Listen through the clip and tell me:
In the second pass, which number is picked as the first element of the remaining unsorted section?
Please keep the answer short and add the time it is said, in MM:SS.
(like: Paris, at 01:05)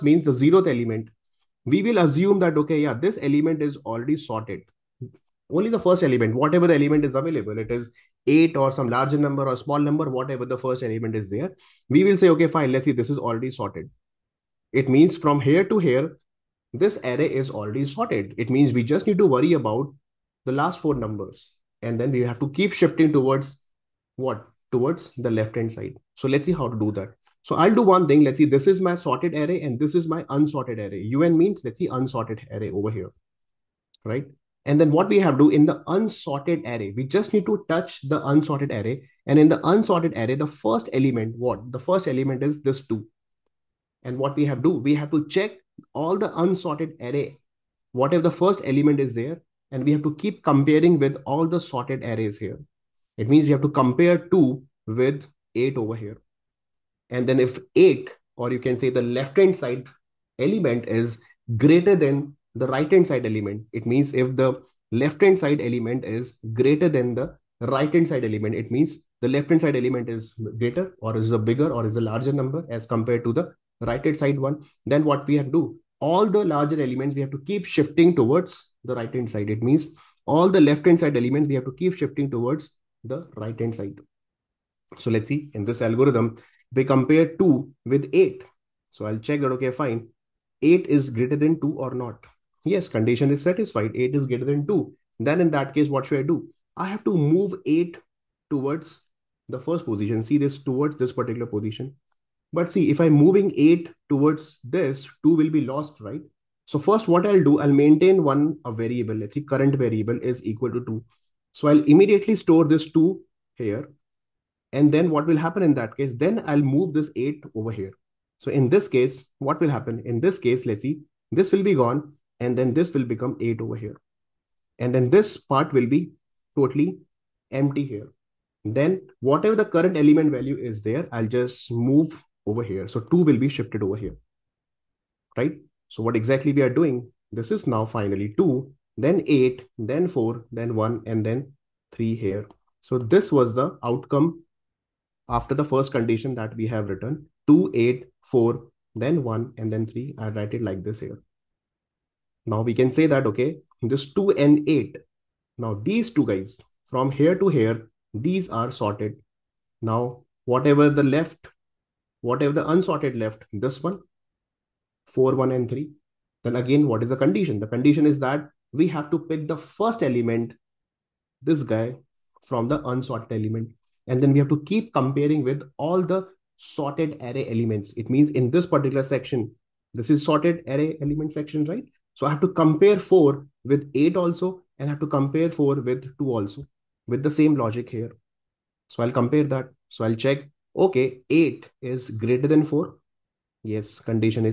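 4, at 02:45.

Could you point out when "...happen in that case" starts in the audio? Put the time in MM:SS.
01:55.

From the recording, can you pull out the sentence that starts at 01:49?
Let's see, current variable is equal to 2.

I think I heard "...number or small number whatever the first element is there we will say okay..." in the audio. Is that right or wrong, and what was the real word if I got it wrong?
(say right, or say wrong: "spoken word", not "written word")
right.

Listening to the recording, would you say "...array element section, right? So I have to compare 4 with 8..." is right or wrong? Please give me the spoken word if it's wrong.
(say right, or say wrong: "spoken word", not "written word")
right.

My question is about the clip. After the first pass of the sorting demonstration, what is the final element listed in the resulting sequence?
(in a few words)
3.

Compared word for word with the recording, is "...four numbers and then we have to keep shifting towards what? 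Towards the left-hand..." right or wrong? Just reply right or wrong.
right.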